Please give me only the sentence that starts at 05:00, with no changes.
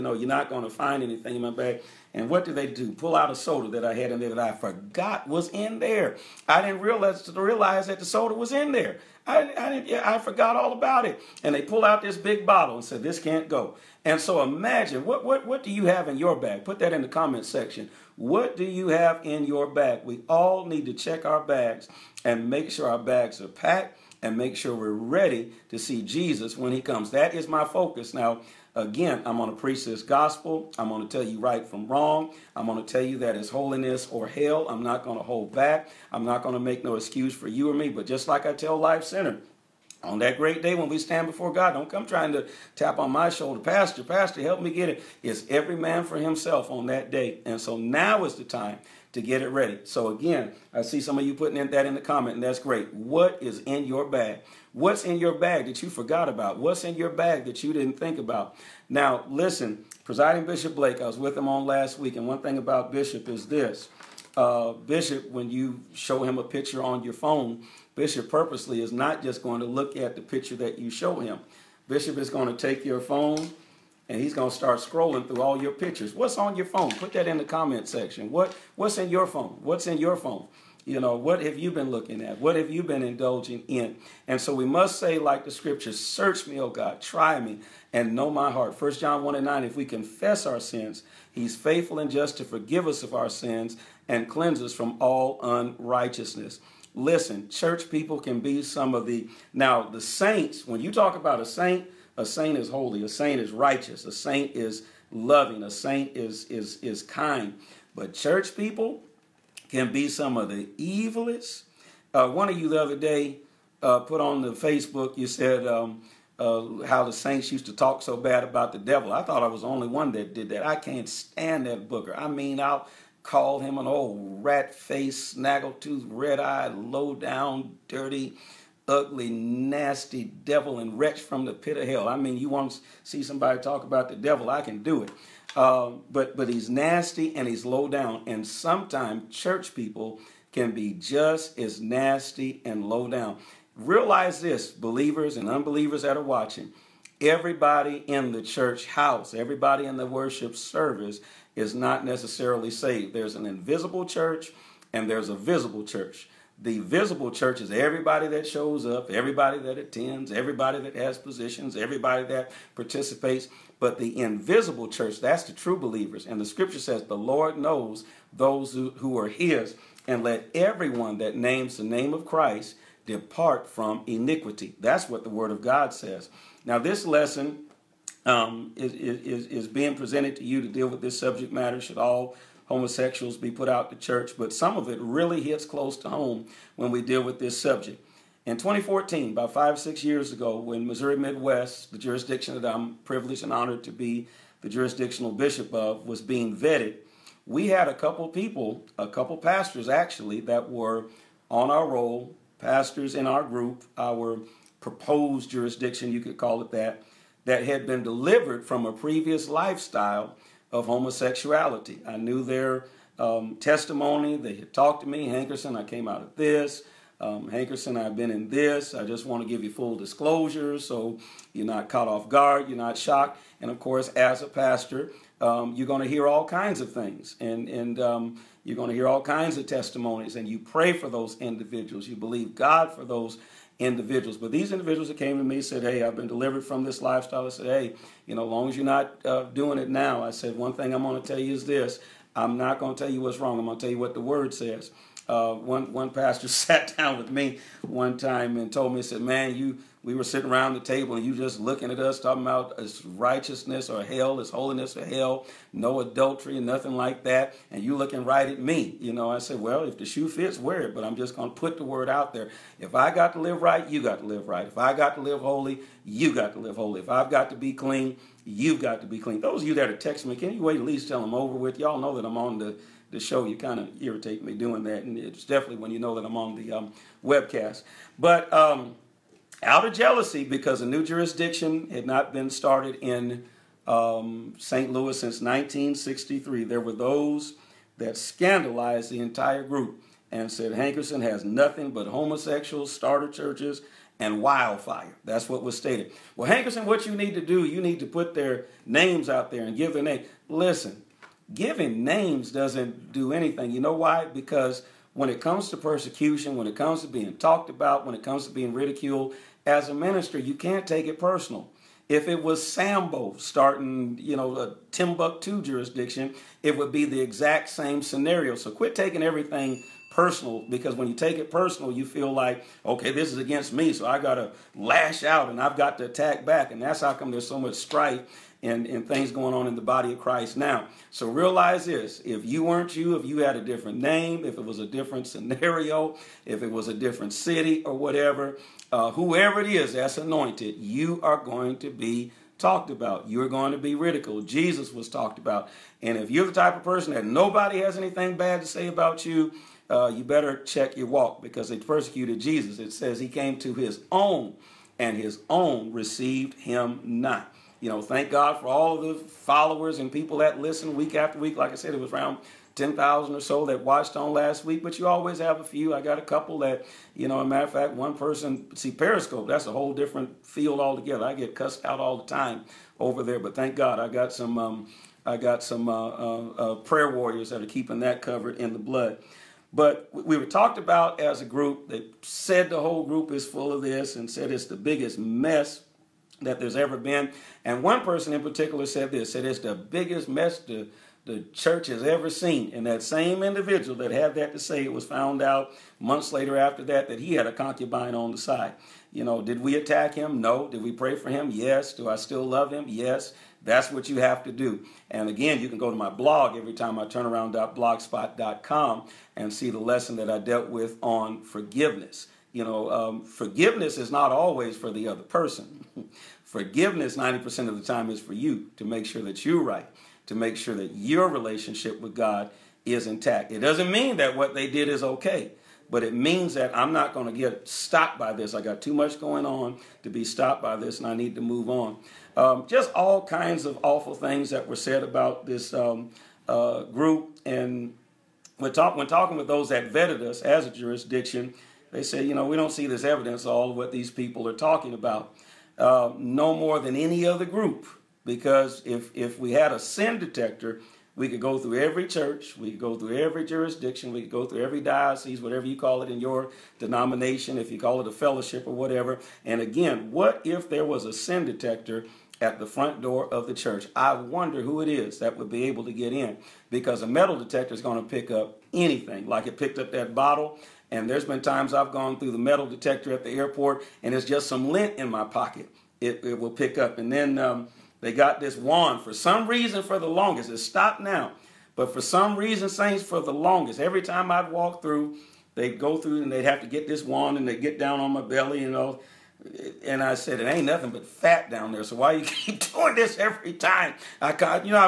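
Listen, giving names doesn't do anything.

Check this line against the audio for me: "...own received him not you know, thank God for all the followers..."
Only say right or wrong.
right.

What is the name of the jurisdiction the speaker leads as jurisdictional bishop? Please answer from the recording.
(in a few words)
Missouri Midwest.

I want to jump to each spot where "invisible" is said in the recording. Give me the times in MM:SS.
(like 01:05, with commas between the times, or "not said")
02:33, 02:44.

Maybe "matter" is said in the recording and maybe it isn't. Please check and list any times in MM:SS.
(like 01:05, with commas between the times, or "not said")
03:01, 06:07.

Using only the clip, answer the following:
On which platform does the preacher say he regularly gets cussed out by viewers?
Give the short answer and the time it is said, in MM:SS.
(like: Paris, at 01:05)
Periscope, at 06:08.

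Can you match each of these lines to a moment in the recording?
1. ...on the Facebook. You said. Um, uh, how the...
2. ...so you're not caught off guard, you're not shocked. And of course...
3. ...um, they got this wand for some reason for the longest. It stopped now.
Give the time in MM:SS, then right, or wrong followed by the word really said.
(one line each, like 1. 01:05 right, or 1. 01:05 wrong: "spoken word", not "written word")
1. 01:54 right
2. 03:40 right
3. 07:57 right.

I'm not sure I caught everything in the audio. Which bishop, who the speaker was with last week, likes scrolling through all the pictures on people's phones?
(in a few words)
Bishop Blake.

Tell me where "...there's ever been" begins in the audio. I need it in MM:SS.
06:26.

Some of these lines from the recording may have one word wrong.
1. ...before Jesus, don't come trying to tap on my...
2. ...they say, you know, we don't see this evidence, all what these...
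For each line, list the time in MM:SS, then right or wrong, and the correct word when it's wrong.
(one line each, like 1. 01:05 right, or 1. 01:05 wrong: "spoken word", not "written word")
1. 00:41 wrong: "God", not "Jesus"
2. 07:21 right.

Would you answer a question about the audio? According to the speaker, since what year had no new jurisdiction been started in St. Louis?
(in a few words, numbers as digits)
1963.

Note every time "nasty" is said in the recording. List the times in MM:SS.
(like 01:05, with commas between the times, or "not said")
02:09, 02:16, 02:21.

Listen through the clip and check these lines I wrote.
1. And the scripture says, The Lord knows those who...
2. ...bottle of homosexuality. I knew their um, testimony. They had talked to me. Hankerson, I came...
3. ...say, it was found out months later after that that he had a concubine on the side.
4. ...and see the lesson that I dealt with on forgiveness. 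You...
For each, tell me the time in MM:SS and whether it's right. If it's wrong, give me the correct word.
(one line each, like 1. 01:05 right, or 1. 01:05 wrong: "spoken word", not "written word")
1. 02:46 right
2. 03:29 wrong: "lifestyle", not "bottle"
3. 06:34 right
4. 06:49 right.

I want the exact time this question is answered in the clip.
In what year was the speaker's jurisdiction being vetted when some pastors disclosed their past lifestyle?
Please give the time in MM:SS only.
03:08.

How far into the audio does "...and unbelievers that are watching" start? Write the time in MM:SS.
02:25.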